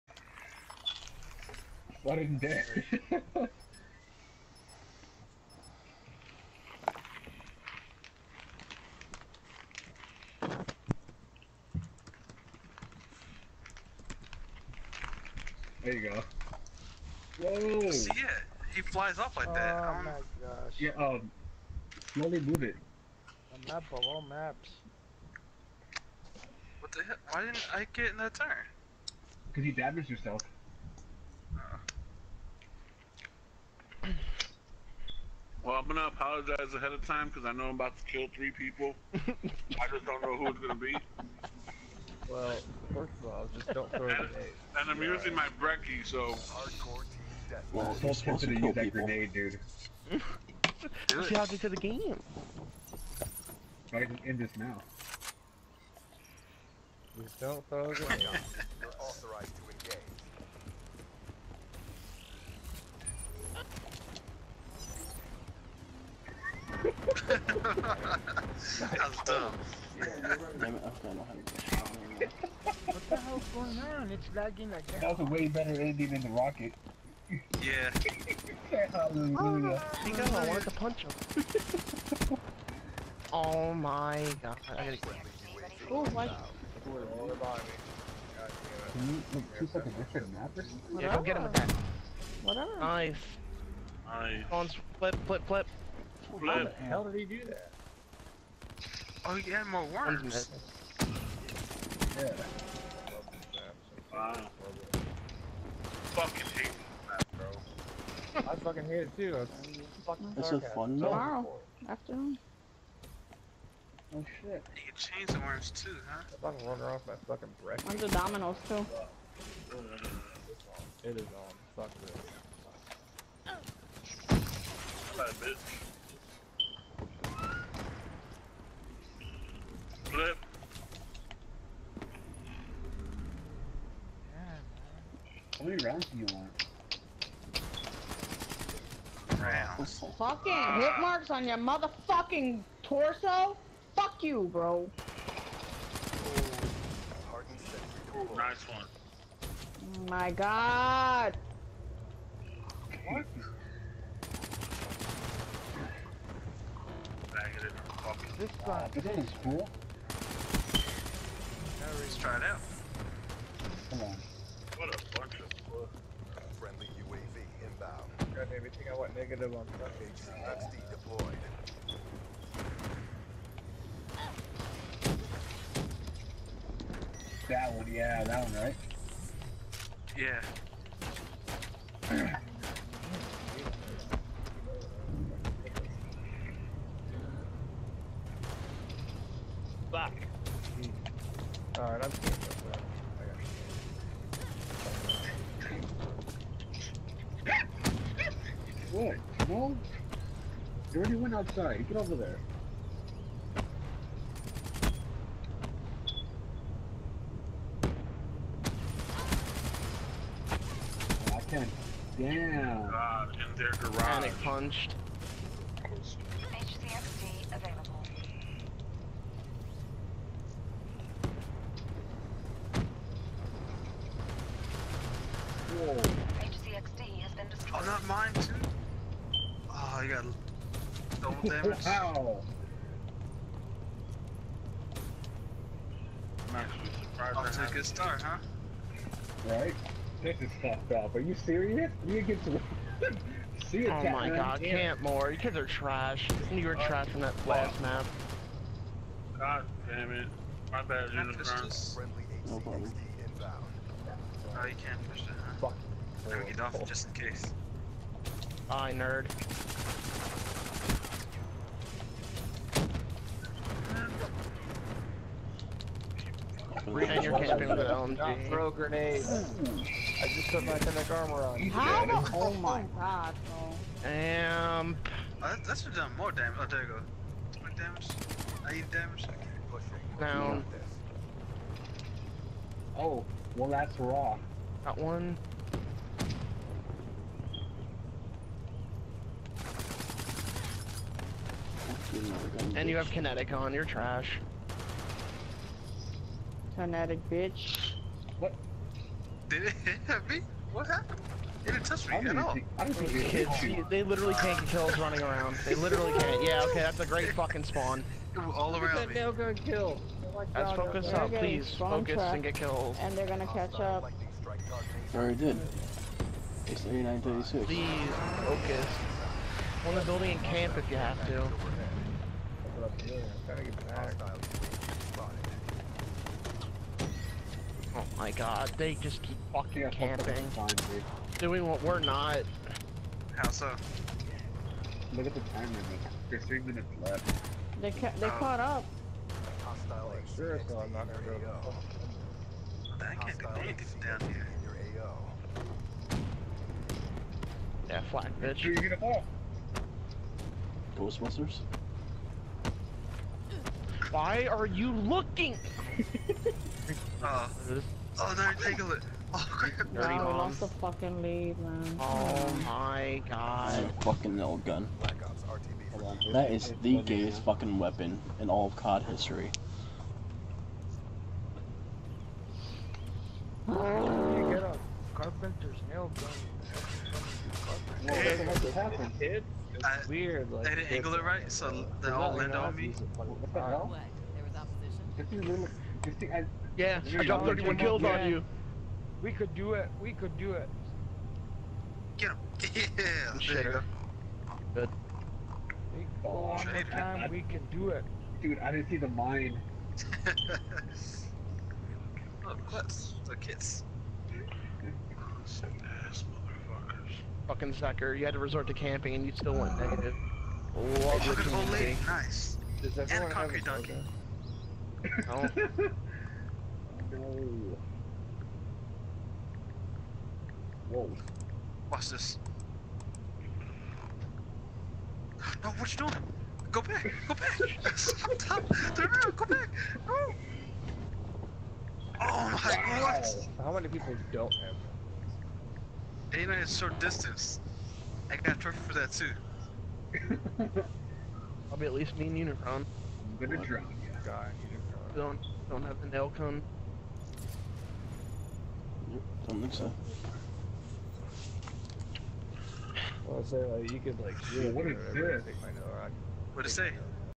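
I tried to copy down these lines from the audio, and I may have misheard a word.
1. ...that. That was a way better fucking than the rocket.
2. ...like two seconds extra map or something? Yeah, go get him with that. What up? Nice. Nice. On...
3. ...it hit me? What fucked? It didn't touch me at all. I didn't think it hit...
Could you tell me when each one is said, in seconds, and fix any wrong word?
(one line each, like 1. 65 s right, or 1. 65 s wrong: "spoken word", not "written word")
1. 74 s wrong: "ending", not "fucking"
2. 89 s right
3. 299 s wrong: "happened", not "fucked".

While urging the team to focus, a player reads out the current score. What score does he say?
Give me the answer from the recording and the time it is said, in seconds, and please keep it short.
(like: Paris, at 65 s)
3936, at 316 s.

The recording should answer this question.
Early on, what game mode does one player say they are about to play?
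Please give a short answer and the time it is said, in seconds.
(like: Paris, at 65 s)
Hardcore team death, at 46 s.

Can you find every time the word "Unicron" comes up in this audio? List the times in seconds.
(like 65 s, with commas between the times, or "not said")
251 s, 442 s.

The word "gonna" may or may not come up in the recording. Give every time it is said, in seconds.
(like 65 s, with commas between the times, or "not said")
35 s, 40 s, 313 s, 341 s, 443 s.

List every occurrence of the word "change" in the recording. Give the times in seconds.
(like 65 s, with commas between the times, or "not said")
114 s.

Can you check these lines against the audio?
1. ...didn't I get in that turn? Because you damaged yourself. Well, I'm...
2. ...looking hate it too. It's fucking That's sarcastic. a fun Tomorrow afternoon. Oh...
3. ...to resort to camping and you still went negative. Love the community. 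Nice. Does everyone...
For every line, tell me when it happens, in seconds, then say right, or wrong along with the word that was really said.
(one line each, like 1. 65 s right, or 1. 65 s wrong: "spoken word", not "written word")
1. 27 s right
2. 108 s wrong: "fucking", not "looking"
3. 408 s right.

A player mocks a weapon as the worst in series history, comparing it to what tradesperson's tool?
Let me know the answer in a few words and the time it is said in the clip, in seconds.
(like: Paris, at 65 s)
Carpenter's nail gun, at 375 s.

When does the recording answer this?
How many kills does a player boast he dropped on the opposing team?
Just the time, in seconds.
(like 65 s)
387 s.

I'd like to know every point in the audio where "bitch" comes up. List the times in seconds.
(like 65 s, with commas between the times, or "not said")
125 s, 297 s, 348 s.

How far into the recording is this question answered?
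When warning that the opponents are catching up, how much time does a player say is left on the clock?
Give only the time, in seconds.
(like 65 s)
336 s.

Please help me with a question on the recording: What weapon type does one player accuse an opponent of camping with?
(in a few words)
LMG.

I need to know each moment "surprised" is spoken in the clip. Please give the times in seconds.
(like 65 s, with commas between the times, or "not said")
237 s.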